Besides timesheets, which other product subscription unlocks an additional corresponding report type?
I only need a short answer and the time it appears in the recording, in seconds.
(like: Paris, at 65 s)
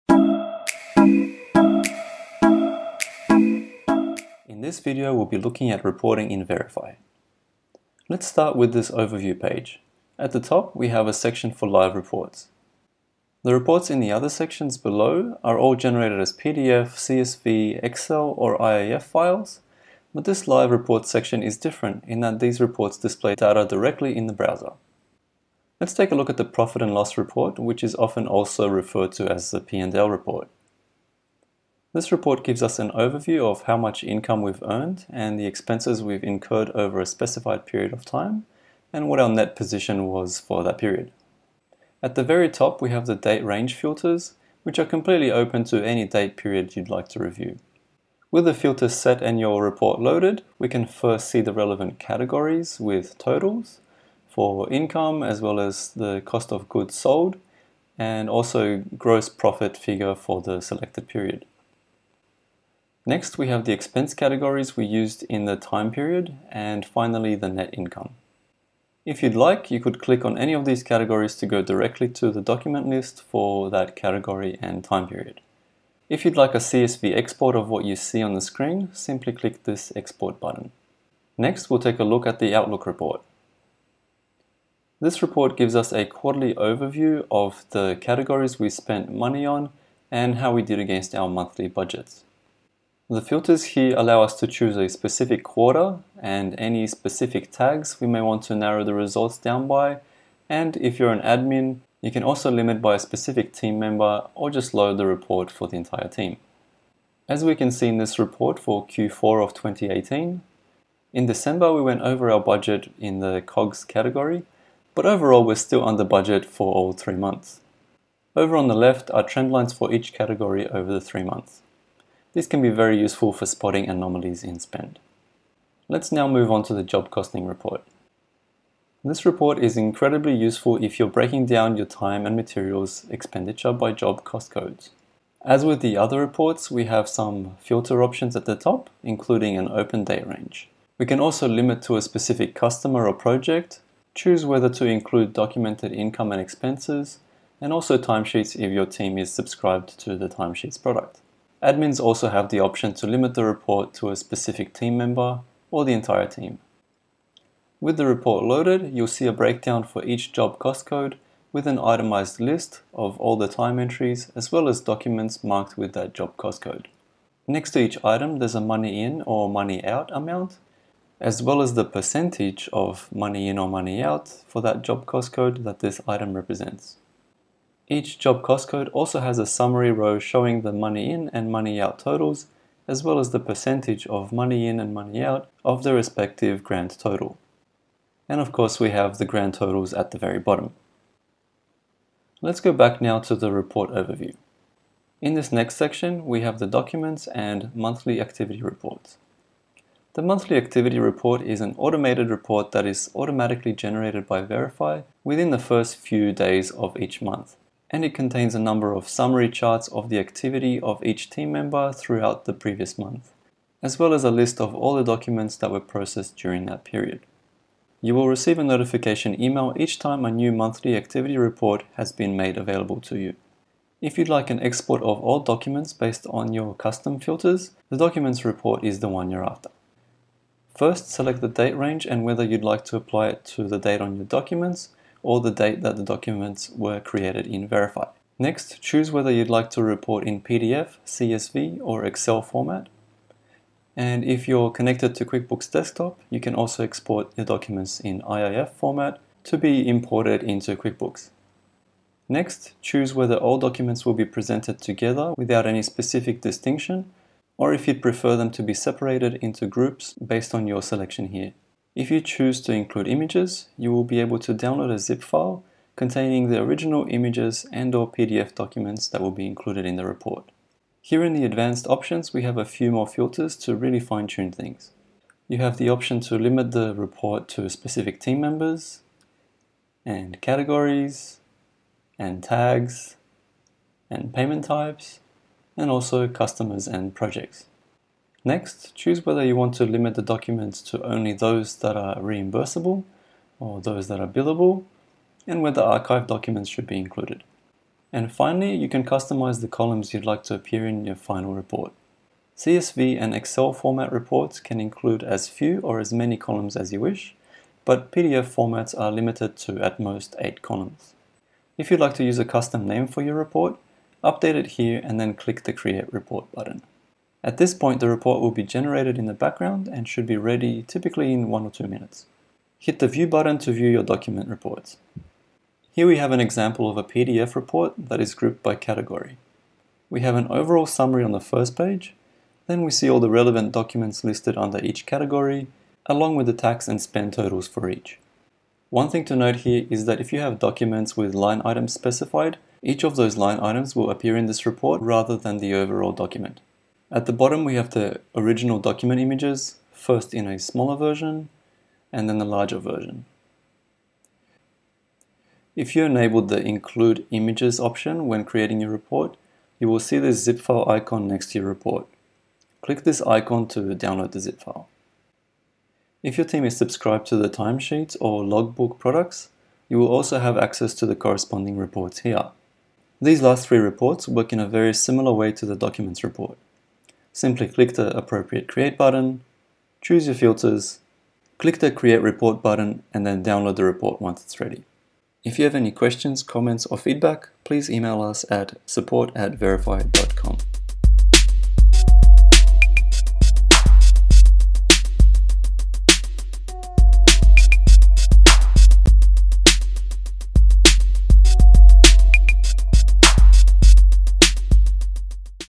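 logbook, at 368 s.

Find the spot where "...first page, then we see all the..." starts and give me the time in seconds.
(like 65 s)
331 s.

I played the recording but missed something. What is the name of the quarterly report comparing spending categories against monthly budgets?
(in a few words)
Outlook report.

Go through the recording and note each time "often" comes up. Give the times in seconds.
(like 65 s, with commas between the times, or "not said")
27 s.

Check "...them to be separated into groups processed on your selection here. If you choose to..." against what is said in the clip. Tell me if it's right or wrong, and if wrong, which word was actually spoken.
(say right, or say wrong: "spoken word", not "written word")
wrong: "based", not "processed".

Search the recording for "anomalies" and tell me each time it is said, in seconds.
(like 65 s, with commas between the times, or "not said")
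123 s.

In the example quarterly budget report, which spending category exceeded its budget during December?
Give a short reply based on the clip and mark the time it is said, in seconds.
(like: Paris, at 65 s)
COGS, at 113 s.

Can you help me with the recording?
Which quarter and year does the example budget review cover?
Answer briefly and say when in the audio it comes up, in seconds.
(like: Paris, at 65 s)
Q4 of 2018, at 108 s.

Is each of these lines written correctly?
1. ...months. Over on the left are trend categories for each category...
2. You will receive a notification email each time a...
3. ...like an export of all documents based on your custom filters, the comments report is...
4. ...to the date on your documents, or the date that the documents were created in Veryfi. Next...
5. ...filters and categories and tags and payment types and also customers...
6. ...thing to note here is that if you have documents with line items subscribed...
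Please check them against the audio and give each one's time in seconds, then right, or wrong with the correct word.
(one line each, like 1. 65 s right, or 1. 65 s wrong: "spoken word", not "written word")
1. 117 s wrong: "lines", not "categories"
2. 217 s right
3. 224 s wrong: "documents", not "comments"
4. 233 s right
5. 278 s wrong: "members", not "filters"
6. 339 s wrong: "specified", not "subscribed".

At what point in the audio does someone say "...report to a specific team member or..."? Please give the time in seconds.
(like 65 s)
153 s.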